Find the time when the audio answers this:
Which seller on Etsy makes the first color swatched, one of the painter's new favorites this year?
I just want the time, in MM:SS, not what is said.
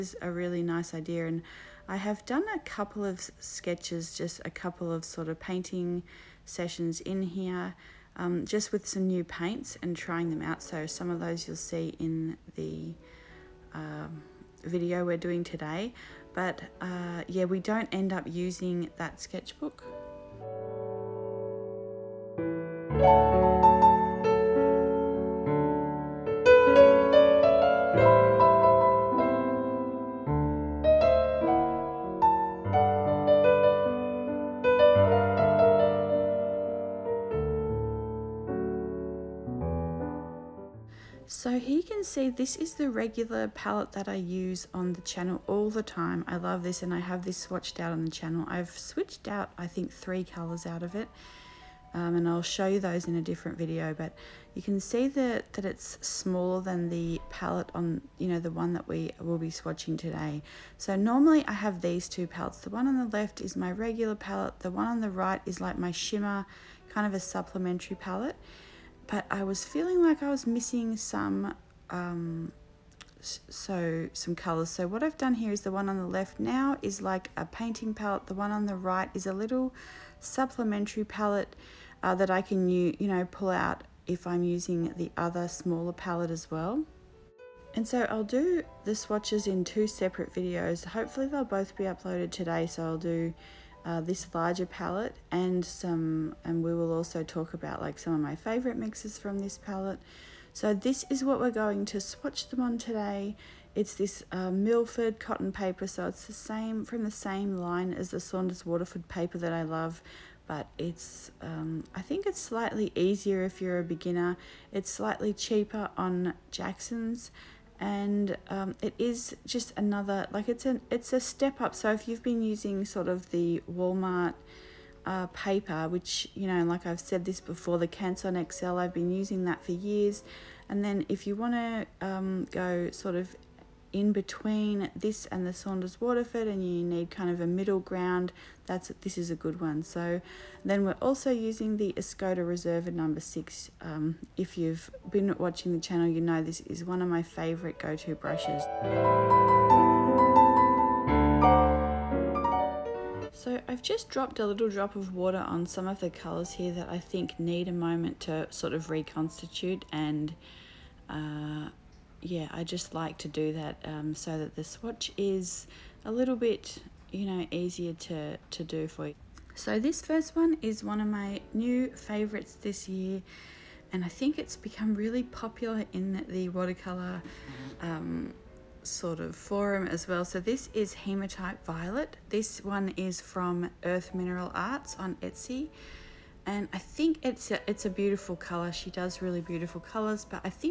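03:03.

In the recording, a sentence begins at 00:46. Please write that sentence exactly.
I love this and I have this swatched out on the channel.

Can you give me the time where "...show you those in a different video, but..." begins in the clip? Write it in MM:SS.
00:52.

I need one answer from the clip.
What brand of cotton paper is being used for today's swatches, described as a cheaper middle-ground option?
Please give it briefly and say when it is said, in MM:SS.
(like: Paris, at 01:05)
Milford, at 01:44.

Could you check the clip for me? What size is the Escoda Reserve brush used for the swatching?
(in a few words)
6.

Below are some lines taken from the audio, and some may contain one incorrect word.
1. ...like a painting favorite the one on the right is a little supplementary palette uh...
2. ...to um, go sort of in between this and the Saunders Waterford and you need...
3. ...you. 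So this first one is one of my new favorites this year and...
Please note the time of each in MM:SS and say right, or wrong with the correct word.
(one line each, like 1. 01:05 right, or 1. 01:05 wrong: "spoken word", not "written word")
1. 01:17 wrong: "palette", not "favorite"
2. 02:11 right
3. 02:49 right.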